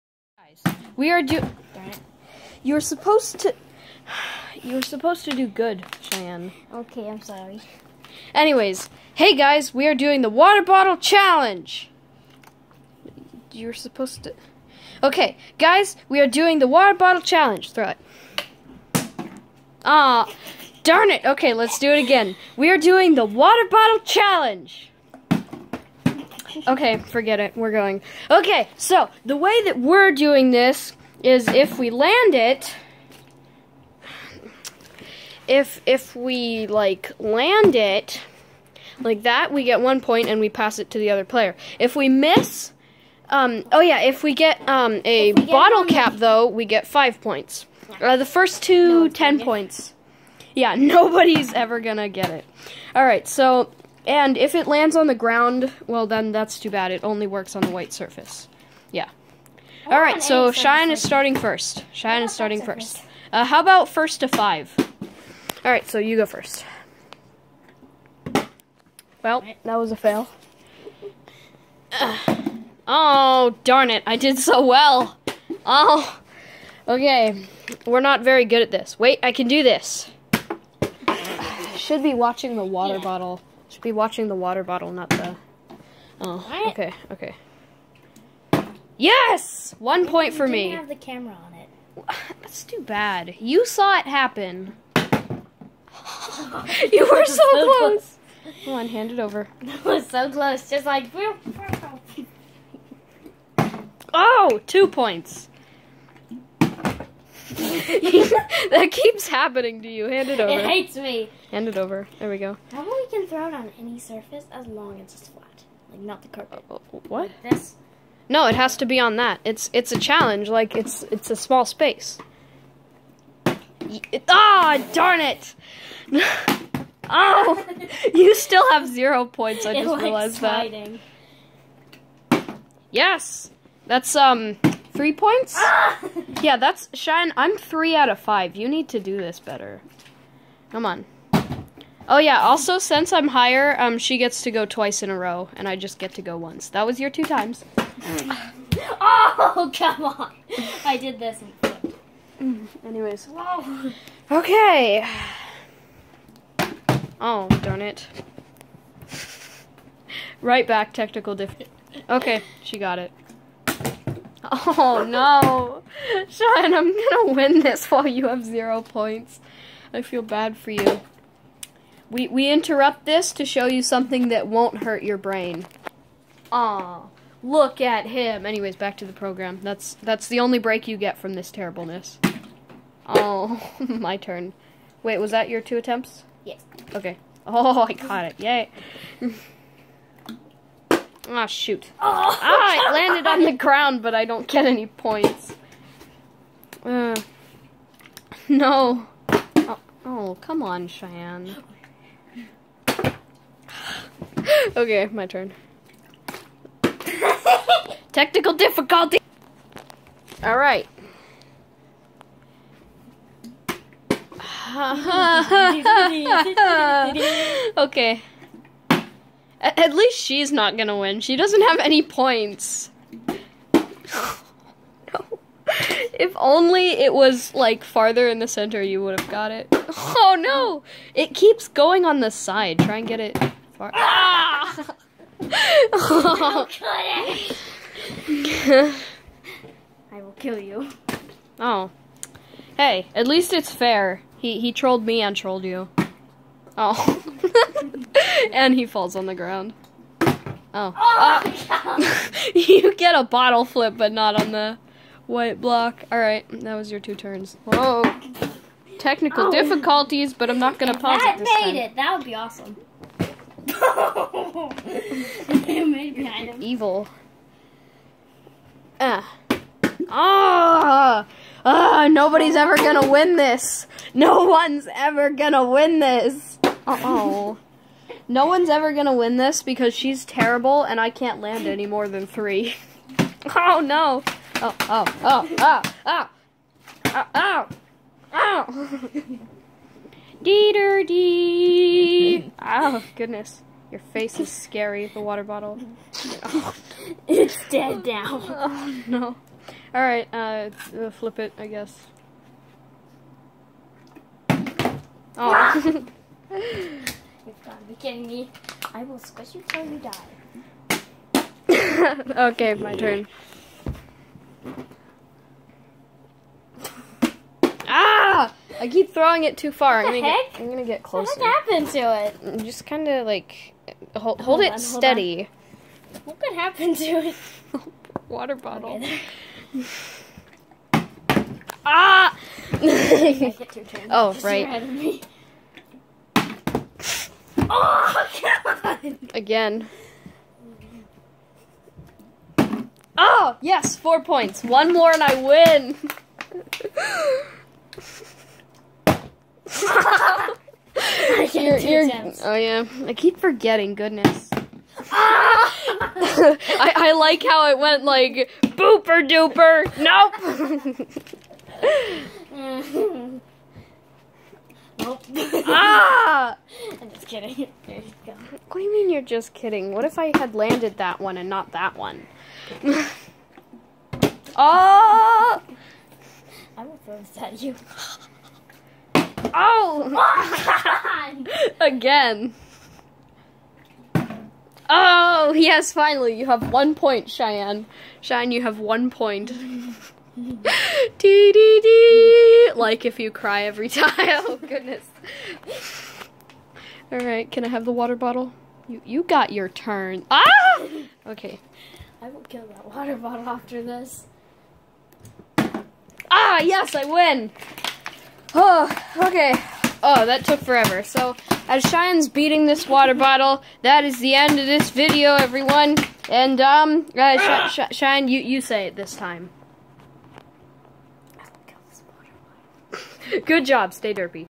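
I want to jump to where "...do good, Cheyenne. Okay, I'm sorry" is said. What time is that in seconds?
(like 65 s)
5 s.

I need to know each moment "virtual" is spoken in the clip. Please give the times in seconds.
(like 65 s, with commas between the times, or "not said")
not said.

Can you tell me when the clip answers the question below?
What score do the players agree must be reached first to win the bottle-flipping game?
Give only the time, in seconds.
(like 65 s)
63 s.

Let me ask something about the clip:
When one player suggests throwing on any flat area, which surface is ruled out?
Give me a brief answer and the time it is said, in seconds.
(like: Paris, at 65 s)
carpet, at 116 s.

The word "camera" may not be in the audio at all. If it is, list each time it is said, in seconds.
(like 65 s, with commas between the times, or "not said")
90 s.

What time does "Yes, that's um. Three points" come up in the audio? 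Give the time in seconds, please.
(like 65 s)
132 s.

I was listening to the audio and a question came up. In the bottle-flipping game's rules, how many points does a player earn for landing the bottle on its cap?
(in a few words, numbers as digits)
10.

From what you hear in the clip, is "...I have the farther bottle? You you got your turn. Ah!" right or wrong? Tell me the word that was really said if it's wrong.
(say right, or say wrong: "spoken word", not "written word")
wrong: "water", not "farther".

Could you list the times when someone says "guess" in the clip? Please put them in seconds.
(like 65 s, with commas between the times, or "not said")
301 s.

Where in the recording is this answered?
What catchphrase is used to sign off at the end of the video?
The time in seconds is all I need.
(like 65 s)
423 s.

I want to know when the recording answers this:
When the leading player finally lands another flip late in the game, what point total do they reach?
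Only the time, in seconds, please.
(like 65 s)
343 s.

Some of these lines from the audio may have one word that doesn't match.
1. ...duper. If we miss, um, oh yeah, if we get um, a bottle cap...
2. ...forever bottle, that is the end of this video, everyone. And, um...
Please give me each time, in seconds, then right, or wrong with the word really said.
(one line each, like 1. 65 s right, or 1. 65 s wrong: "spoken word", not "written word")
1. 41 s wrong: "player", not "duper"
2. 412 s wrong: "water", not "forever".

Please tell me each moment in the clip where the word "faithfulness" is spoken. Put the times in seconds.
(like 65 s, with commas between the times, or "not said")
not said.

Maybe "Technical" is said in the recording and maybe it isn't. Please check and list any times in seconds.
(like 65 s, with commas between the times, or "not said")
160 s, 208 s, 258 s.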